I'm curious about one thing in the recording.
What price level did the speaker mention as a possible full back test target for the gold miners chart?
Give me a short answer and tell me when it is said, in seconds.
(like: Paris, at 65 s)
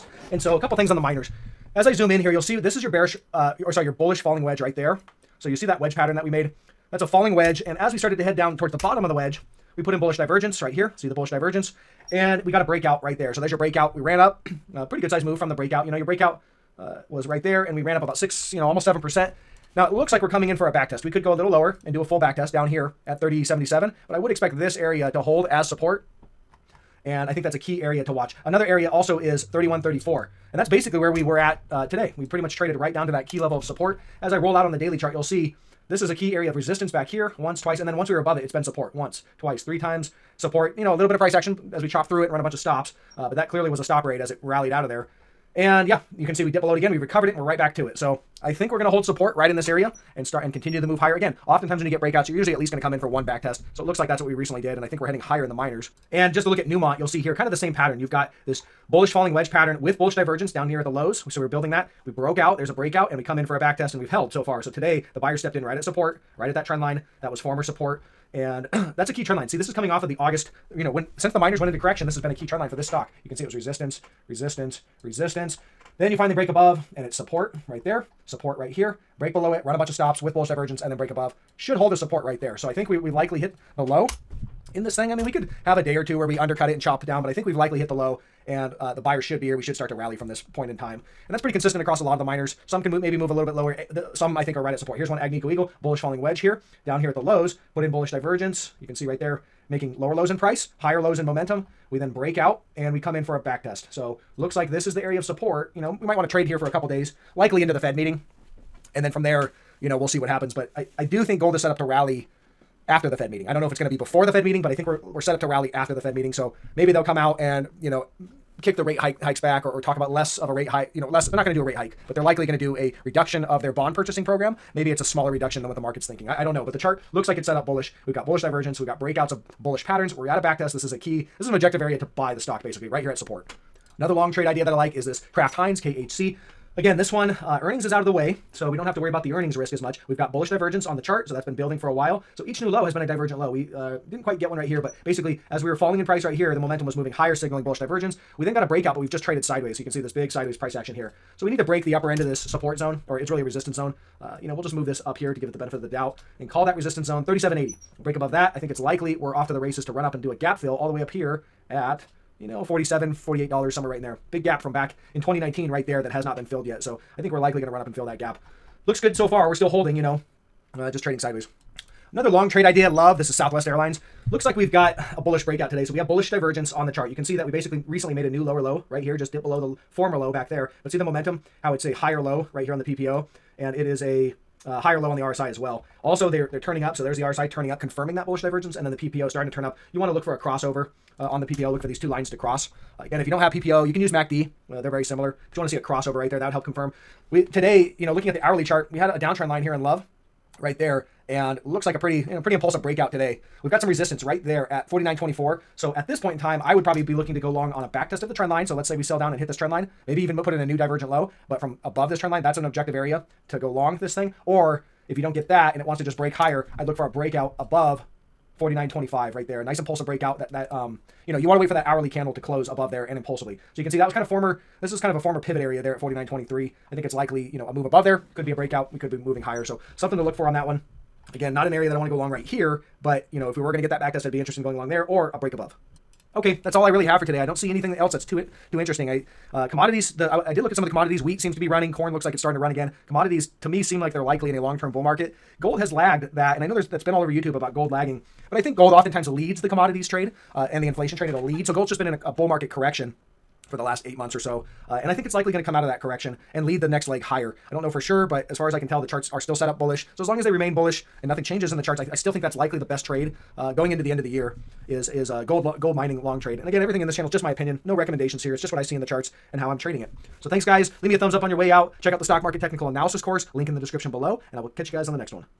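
3077, at 23 s.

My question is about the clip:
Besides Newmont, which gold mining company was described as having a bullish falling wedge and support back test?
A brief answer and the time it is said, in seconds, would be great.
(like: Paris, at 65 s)
Agnico Eagle, at 95 s.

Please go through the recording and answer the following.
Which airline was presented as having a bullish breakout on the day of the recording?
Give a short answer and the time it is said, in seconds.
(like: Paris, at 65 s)
Southwest Airlines, at 173 s.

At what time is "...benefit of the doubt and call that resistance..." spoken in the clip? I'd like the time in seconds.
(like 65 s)
155 s.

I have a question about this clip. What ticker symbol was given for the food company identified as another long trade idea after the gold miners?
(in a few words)
KHC.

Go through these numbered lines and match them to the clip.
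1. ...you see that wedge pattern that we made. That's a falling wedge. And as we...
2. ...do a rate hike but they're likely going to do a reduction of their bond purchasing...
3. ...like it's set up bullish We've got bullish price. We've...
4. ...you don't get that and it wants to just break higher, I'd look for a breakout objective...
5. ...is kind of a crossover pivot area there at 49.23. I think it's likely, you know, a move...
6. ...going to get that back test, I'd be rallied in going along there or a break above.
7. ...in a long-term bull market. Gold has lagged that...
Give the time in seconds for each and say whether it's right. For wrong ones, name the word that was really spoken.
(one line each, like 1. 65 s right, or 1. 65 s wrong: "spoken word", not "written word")
1. 5 s right
2. 121 s right
3. 127 s wrong: "divergence", not "price"
4. 215 s wrong: "above", not "objective"
5. 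224 s wrong: "former", not "crossover"
6. 233 s wrong: "interested", not "rallied"
7. 244 s right.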